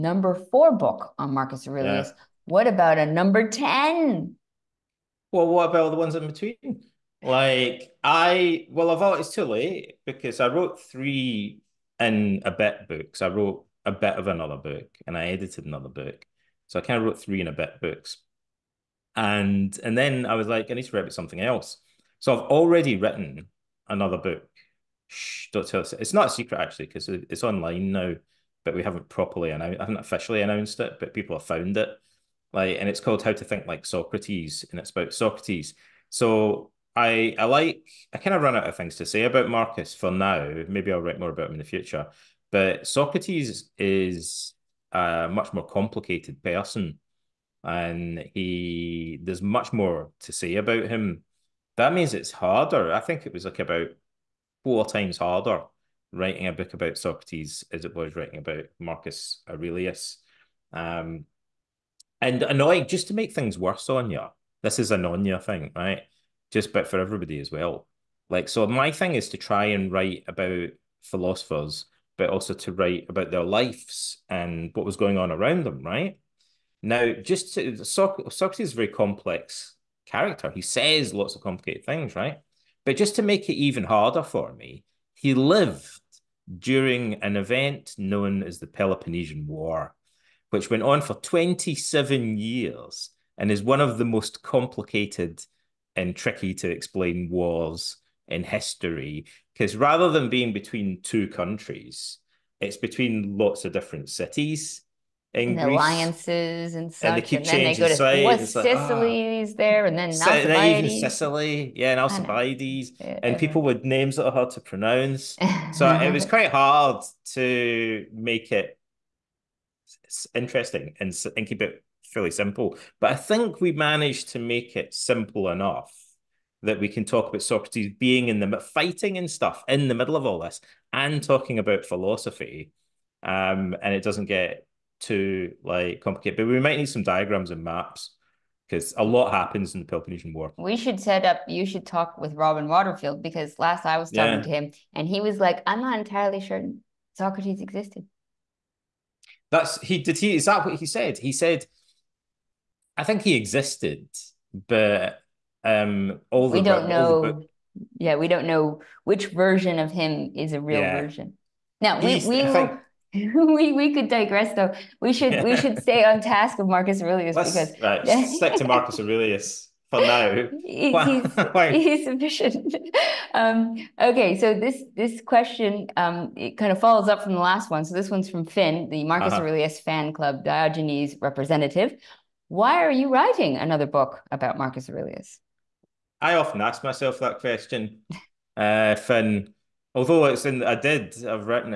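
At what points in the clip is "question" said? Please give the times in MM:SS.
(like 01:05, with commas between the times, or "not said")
02:55, 03:07.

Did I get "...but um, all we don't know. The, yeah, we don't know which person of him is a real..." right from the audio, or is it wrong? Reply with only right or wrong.
wrong.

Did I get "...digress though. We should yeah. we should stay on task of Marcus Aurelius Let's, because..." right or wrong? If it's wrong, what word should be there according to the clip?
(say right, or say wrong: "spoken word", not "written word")
right.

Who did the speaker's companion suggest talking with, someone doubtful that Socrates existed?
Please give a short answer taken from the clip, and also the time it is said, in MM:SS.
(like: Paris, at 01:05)
Robin Waterfield, at 02:22.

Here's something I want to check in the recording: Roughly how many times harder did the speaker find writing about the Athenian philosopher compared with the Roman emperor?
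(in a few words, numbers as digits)
4.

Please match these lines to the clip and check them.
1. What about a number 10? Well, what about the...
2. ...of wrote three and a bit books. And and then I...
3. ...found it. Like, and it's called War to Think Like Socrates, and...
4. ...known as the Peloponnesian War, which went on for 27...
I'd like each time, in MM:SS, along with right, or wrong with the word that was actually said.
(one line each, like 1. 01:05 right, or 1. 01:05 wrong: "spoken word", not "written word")
1. 00:02 right
2. 00:17 right
3. 00:31 wrong: "How", not "War"
4. 01:27 right.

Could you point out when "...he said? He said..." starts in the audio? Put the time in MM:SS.
02:30.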